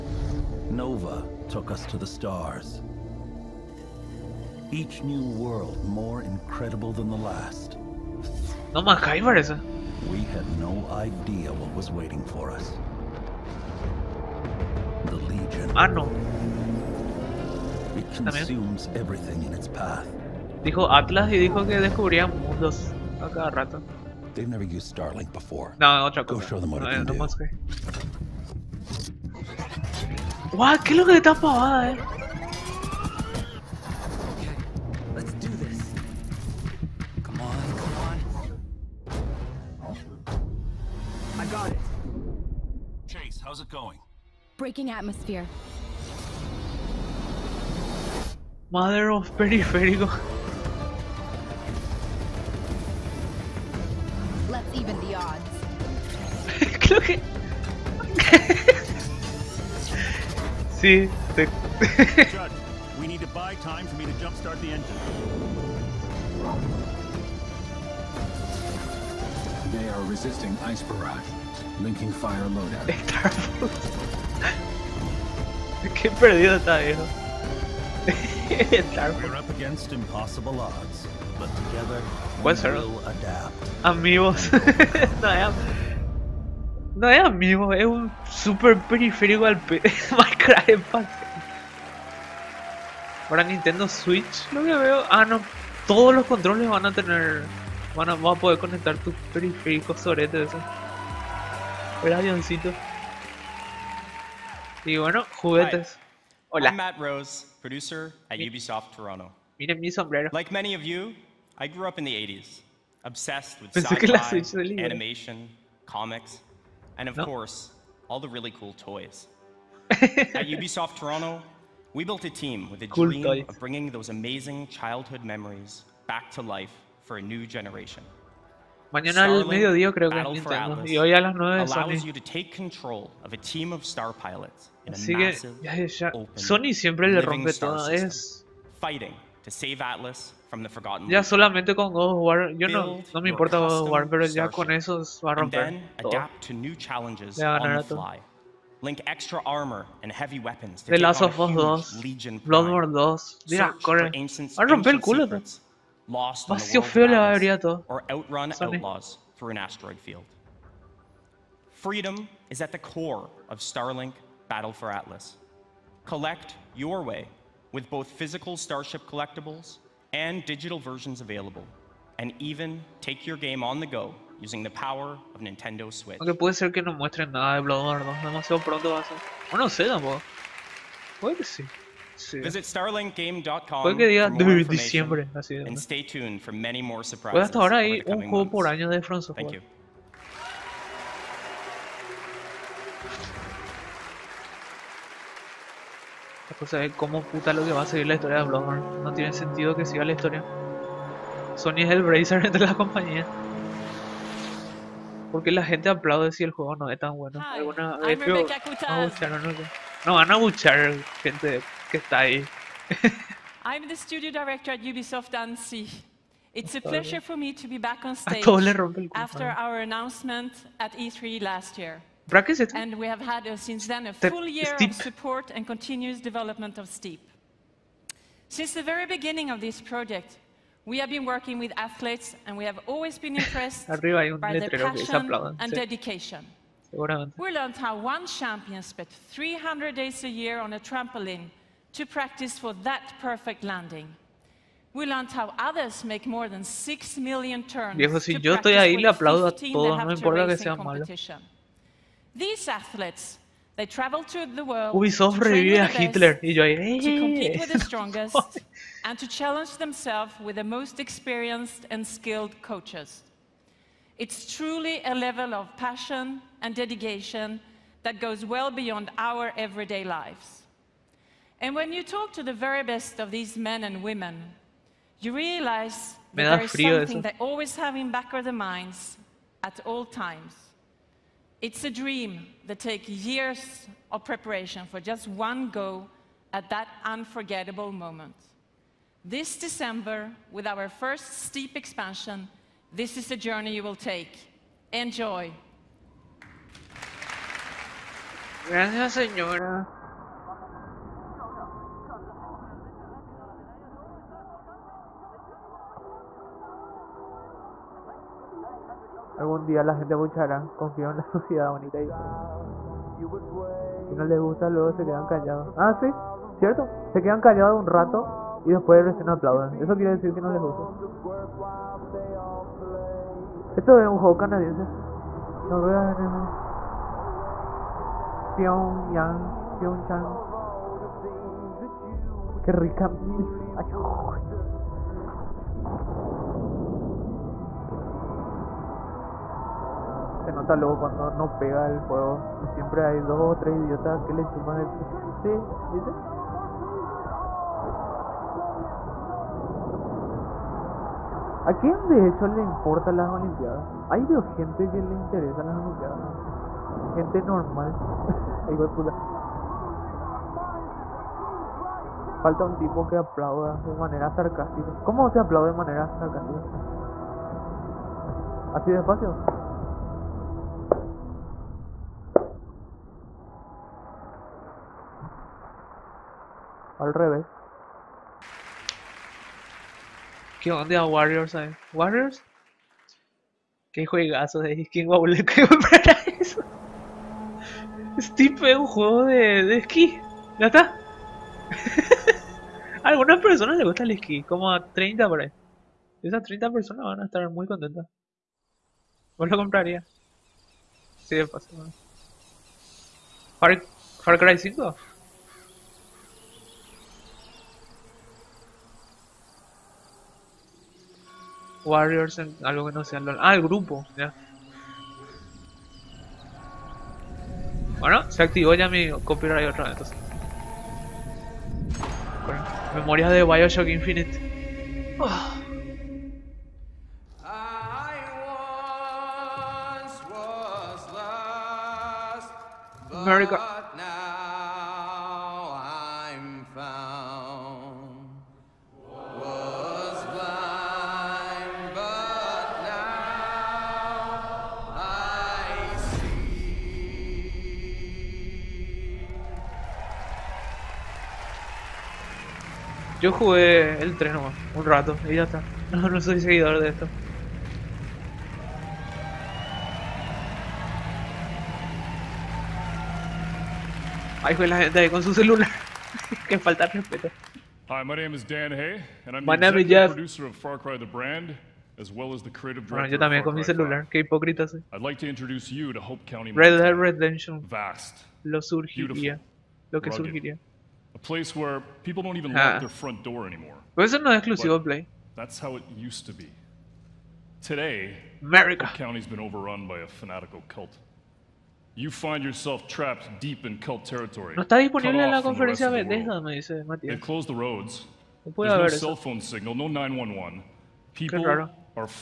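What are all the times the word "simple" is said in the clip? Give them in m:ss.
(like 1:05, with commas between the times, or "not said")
not said.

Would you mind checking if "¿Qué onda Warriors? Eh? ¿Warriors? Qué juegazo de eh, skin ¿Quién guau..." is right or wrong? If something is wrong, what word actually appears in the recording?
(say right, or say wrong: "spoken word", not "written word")
right.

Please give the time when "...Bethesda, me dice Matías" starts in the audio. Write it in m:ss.
8:16.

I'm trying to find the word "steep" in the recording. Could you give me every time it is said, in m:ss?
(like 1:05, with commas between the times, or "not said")
3:46, 4:51, 6:28.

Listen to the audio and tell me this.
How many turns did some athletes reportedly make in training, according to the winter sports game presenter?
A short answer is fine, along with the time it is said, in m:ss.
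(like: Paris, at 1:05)
6 million, at 4:06.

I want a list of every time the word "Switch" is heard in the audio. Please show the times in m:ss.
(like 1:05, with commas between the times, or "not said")
1:33, 2:55.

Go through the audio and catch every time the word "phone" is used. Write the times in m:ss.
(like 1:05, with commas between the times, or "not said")
8:19.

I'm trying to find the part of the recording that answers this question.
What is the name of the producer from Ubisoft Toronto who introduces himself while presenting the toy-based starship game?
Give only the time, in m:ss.
1:46.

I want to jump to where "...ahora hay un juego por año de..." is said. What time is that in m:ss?
3:07.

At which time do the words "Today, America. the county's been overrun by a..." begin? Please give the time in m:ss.
8:07.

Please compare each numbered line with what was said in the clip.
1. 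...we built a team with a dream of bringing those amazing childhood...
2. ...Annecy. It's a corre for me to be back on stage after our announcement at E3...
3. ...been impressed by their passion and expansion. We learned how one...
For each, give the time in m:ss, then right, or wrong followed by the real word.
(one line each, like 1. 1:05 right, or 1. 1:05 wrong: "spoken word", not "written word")
1. 2:01 right
2. 3:35 wrong: "pleasure", not "corre"
3. 3:53 wrong: "dedication", not "expansion".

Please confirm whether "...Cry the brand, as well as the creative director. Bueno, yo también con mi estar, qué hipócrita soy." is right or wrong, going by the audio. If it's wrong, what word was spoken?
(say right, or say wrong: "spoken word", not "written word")
wrong: "celular", not "estar".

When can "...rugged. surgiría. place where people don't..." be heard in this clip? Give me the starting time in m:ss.
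8:00.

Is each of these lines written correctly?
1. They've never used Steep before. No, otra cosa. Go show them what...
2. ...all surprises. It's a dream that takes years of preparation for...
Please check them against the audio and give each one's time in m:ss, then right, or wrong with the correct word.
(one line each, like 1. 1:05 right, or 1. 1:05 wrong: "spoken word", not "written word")
1. 0:24 wrong: "Starlink", not "Steep"
2. 4:39 wrong: "times", not "surprises".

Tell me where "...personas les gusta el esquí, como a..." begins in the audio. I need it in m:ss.
6:33.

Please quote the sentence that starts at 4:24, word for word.
It's truly a level of passion and dedication that goes well beyond our everyday lives.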